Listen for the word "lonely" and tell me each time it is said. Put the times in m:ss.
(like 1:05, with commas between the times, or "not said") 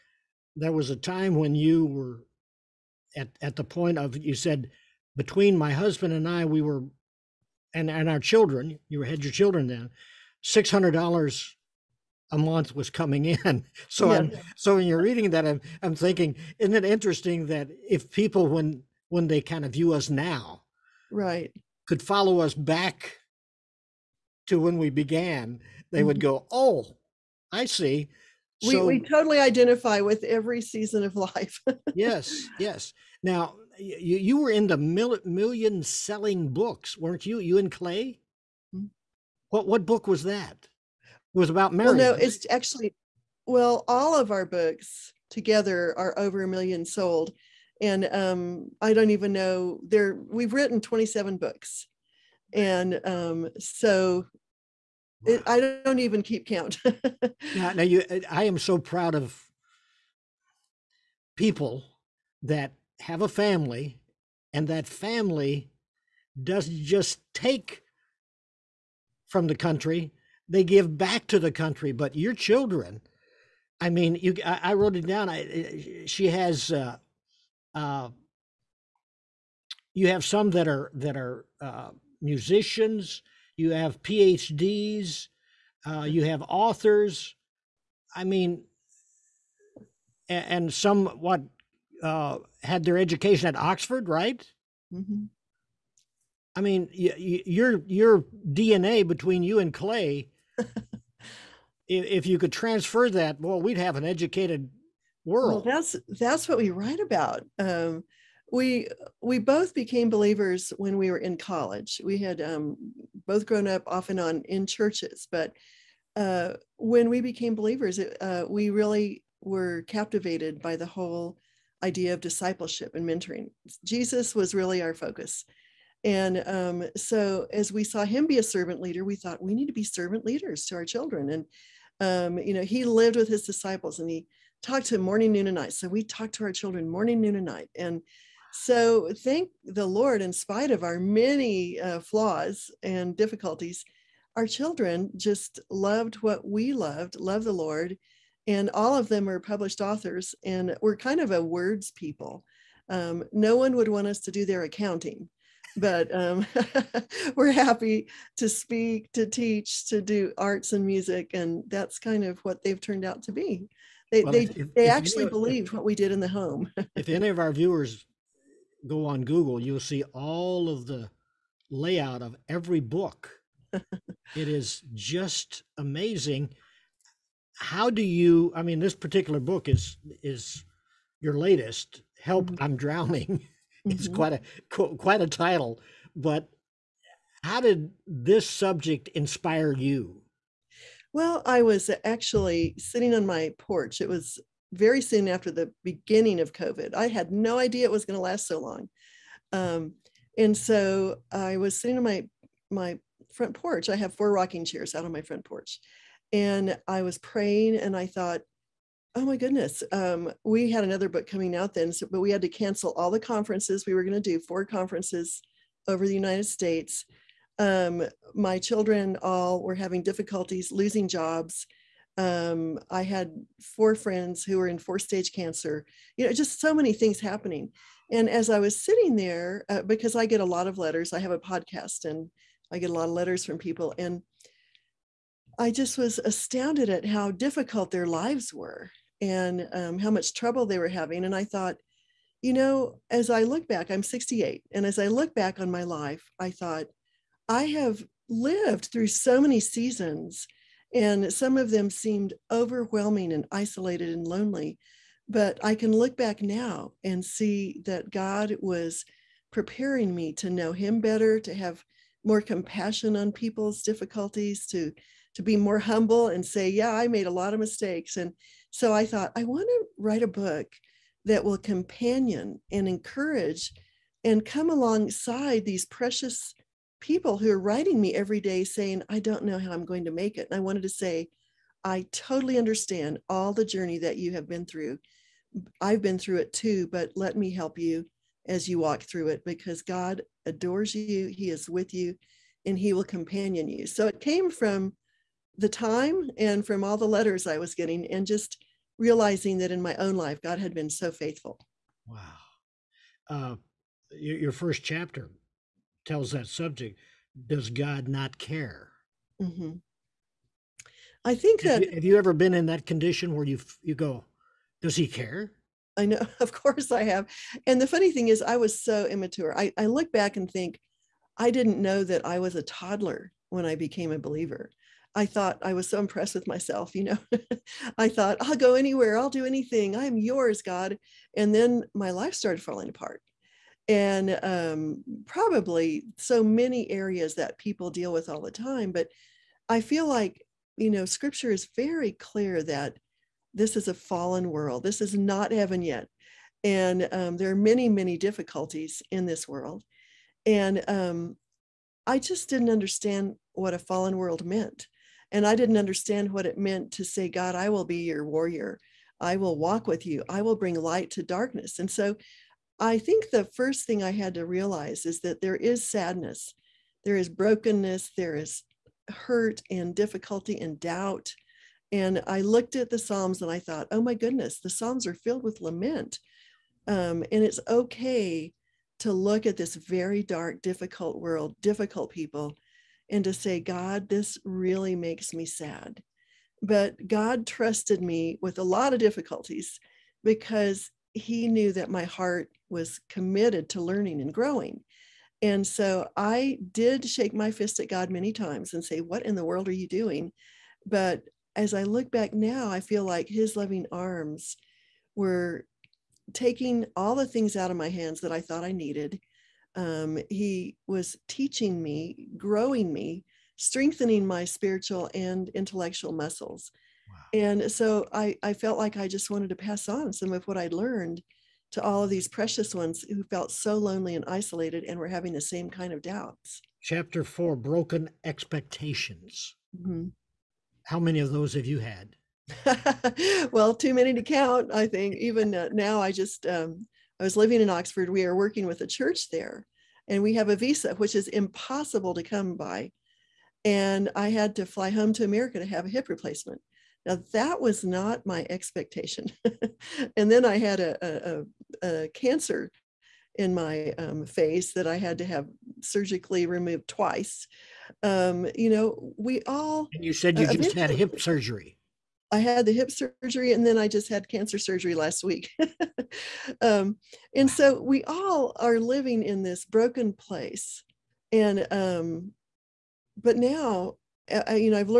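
4:14, 7:03.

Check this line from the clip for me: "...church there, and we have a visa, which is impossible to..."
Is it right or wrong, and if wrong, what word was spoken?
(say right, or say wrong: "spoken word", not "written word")
right.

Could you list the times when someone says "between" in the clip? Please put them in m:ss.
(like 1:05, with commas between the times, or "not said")
0:05, 1:39.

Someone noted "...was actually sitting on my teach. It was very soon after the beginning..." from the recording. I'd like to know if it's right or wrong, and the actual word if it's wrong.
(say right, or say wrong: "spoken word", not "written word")
wrong: "porch", not "teach".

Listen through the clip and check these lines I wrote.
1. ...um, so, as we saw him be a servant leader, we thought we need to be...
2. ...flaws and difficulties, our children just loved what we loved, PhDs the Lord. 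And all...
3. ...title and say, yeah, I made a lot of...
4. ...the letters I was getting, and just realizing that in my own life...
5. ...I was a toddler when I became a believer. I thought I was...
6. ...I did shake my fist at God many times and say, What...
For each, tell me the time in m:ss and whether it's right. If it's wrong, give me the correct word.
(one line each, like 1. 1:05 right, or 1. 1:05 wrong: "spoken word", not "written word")
1. 2:06 right
2. 2:22 wrong: "Love", not "PhDs"
3. 4:25 wrong: "humble", not "title"
4. 4:56 right
5. 5:22 right
6. 6:36 right.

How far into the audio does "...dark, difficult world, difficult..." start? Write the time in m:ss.
6:20.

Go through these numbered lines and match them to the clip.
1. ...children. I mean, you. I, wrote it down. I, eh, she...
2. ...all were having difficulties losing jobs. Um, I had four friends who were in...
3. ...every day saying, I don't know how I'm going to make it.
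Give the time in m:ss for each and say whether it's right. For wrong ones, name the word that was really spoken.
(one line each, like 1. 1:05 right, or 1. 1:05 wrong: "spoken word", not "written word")
1. 1:12 right
2. 3:39 right
3. 4:38 right.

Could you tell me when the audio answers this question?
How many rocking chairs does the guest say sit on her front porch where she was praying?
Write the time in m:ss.
3:24.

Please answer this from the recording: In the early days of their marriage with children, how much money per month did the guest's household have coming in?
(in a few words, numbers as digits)
$600.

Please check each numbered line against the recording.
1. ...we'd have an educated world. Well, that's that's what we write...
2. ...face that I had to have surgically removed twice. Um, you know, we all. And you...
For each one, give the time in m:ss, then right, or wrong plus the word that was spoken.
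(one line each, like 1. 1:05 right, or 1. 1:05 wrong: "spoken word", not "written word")
1. 1:43 right
2. 7:34 right.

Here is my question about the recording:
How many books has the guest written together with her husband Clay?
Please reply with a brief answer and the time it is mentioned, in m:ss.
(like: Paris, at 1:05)
27, at 0:50.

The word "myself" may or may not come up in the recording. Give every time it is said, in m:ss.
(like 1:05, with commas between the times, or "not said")
5:26.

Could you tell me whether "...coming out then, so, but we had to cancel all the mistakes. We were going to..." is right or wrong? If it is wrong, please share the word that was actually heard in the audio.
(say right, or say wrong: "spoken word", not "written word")
wrong: "conferences", not "mistakes".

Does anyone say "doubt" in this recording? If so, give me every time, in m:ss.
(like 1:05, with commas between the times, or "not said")
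6:10, 7:06.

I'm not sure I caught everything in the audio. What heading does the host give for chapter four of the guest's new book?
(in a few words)
Broken Expectations.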